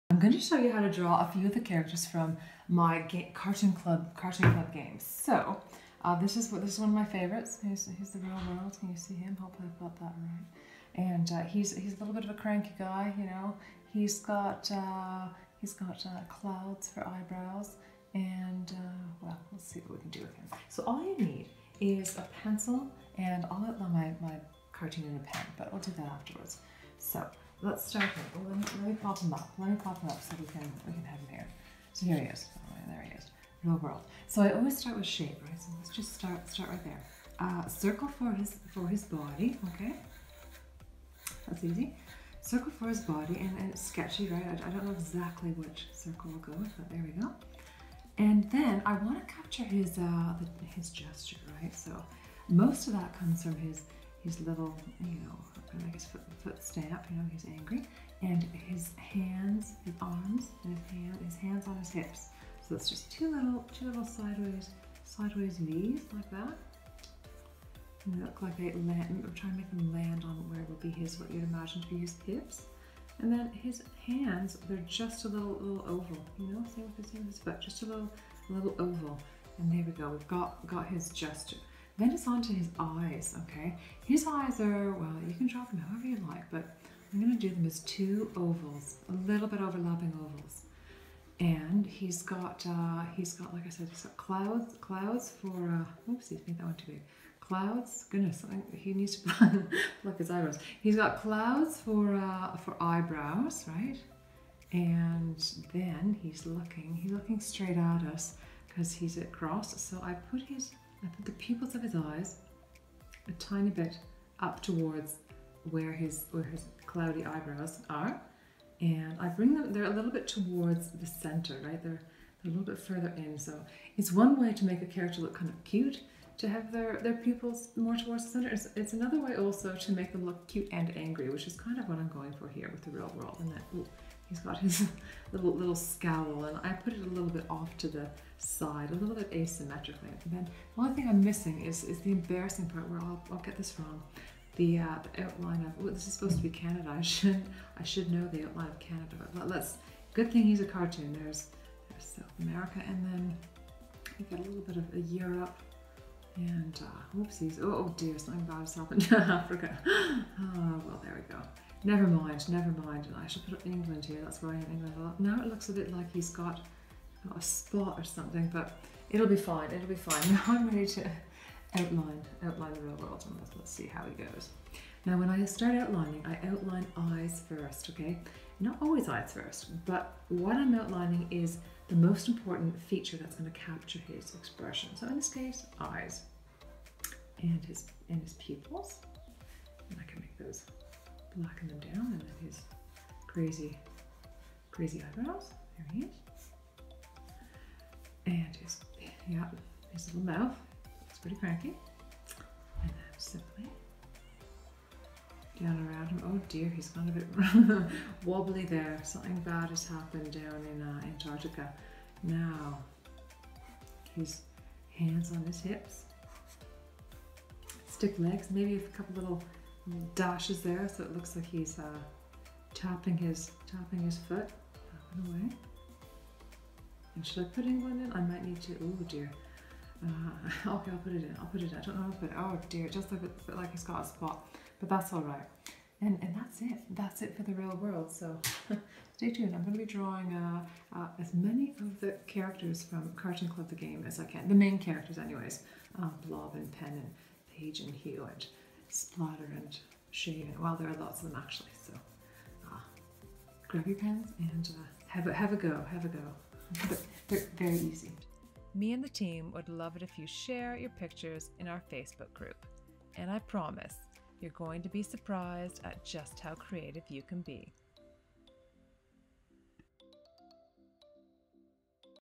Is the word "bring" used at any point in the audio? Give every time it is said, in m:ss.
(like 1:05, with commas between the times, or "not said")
1:59.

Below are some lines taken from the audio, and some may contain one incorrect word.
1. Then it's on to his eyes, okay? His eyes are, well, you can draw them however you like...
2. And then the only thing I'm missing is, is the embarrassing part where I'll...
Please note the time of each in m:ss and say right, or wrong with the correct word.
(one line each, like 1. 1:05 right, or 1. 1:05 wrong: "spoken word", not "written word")
1. 1:22 right
2. 2:20 right.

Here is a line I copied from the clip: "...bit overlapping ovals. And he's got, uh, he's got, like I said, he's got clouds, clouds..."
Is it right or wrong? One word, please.
right.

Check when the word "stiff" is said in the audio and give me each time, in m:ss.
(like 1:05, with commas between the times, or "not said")
3:37.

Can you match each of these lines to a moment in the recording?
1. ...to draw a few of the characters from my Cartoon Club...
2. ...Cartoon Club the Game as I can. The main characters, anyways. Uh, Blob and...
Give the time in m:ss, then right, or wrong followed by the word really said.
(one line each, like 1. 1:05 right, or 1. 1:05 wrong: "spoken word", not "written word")
1. 0:00 right
2. 4:03 right.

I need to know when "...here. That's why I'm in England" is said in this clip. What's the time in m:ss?
2:44.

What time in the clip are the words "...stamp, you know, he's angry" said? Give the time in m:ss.
0:56.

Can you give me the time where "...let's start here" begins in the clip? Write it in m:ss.
0:27.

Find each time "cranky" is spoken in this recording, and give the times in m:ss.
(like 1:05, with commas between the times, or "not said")
0:12, 3:21.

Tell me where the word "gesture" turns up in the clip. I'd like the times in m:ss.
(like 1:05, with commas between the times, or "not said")
0:50, 1:21.